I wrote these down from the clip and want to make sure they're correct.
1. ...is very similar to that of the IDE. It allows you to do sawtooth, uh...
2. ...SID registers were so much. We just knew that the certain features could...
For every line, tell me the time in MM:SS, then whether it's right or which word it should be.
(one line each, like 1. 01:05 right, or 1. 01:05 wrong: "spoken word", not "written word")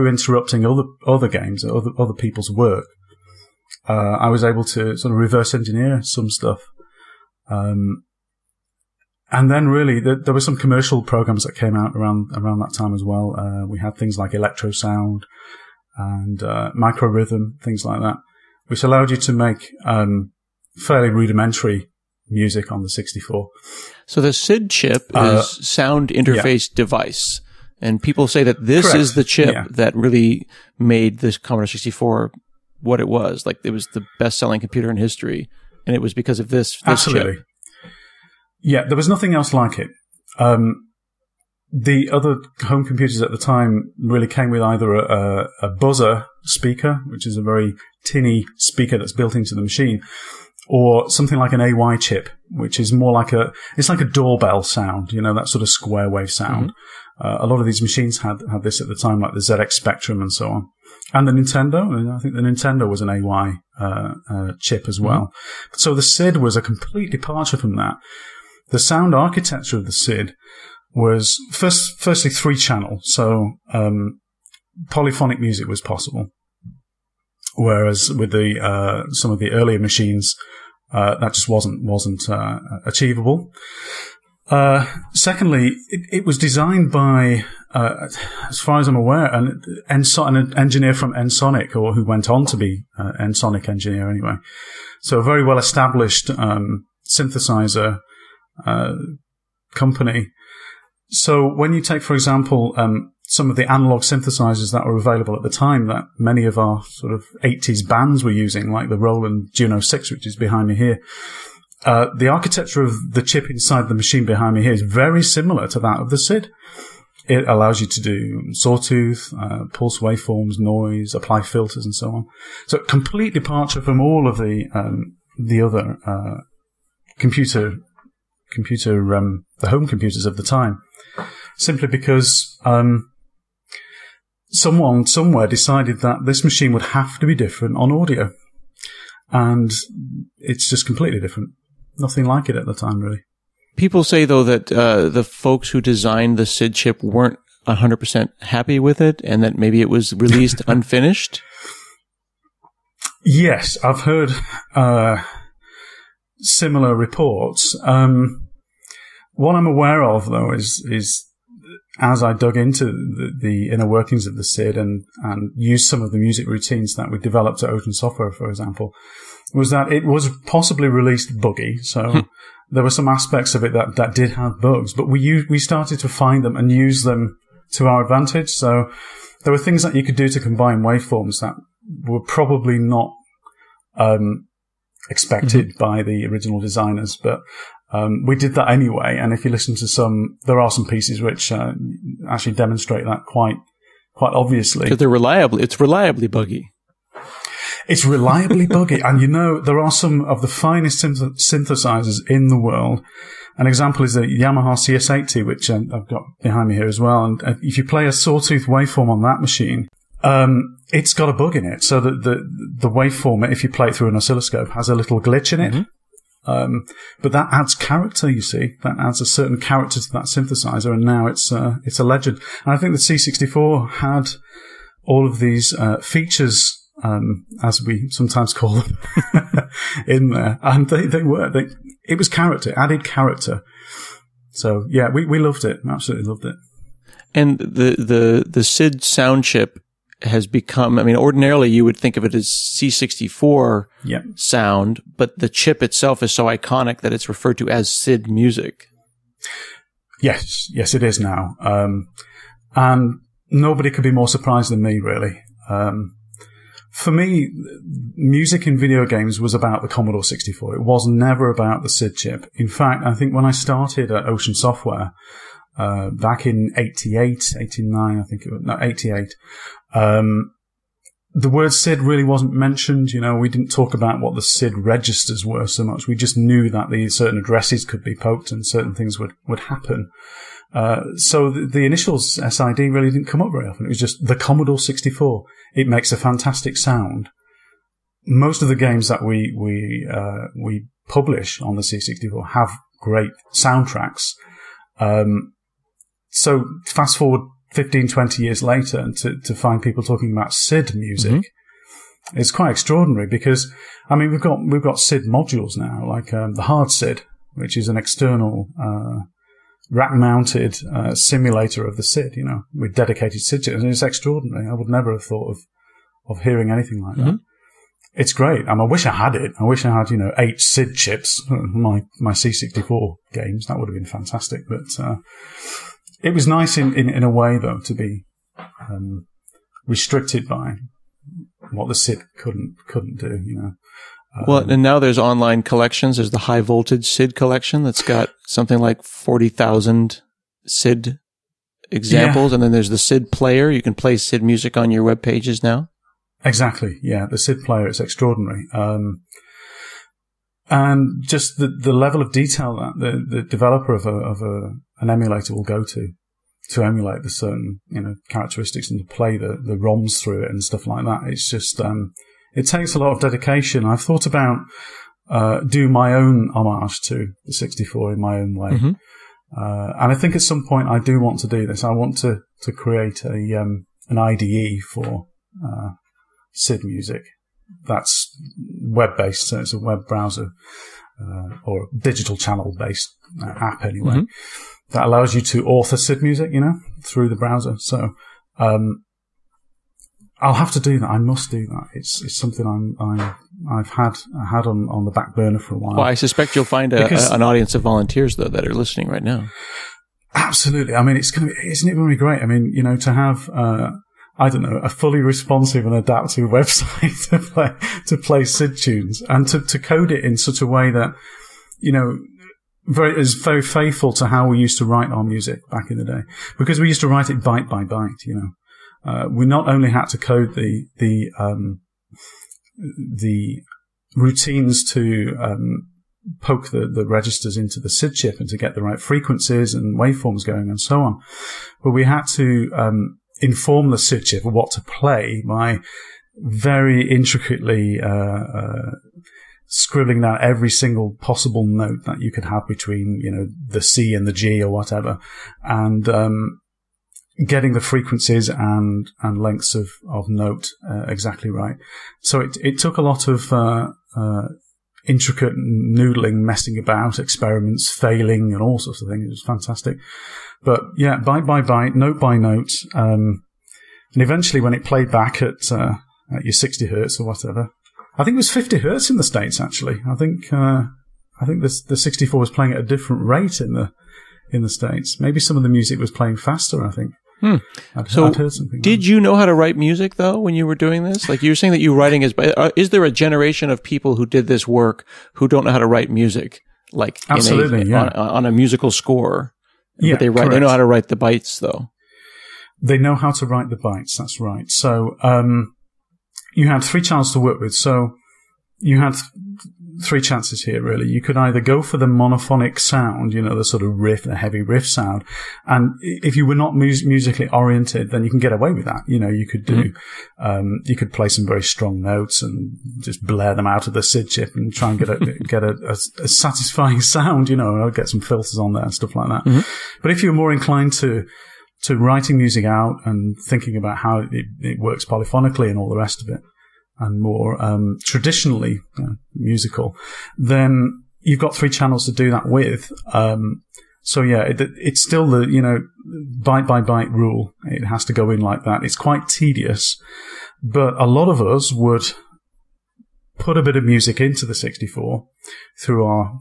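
1. 01:54 wrong: "SID", not "IDE"
2. 04:34 wrong: "addresses", not "features".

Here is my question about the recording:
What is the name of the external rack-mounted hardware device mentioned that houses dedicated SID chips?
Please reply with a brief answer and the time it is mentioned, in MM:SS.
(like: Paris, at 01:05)
Hard SID, at 05:06.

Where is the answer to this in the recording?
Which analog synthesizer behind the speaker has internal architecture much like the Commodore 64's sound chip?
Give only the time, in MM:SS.
01:48.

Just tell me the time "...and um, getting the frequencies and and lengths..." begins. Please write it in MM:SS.
07:25.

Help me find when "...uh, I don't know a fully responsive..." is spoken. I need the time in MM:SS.
06:43.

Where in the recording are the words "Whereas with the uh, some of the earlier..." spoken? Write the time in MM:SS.
01:17.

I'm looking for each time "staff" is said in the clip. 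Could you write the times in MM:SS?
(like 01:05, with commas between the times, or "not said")
not said.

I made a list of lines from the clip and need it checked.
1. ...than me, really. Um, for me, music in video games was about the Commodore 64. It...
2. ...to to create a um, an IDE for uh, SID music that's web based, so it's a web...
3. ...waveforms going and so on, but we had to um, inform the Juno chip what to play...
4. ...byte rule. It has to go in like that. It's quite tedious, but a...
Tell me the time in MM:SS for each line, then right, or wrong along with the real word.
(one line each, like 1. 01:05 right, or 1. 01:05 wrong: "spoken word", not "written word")
1. 04:14 right
2. 06:12 right
3. 07:09 wrong: "SID", not "Juno"
4. 08:56 right.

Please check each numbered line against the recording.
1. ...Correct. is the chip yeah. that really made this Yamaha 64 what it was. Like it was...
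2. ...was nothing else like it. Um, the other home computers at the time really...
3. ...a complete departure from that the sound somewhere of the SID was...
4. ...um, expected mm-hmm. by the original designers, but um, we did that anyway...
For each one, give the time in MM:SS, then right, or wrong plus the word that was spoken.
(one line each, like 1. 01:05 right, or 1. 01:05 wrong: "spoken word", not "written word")
1. 00:28 wrong: "Commodore", not "Yamaha"
2. 00:38 right
3. 01:06 wrong: "architecture", not "somewhere"
4. 03:03 right.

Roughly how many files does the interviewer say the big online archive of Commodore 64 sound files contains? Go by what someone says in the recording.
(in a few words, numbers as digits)
40,000.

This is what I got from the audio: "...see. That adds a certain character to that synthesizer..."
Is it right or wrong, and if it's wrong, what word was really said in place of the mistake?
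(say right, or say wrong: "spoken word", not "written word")
right.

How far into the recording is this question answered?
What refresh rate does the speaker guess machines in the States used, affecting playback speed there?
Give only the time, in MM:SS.
07:48.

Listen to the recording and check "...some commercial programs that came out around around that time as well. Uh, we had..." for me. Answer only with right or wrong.
right.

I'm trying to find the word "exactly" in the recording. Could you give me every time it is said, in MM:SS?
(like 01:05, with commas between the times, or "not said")
05:46, 07:31.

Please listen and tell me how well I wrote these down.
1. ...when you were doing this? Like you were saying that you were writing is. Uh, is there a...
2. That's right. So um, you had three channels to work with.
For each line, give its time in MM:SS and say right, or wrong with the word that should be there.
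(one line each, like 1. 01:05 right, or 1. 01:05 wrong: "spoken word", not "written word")
1. 08:00 right
2. 08:14 right.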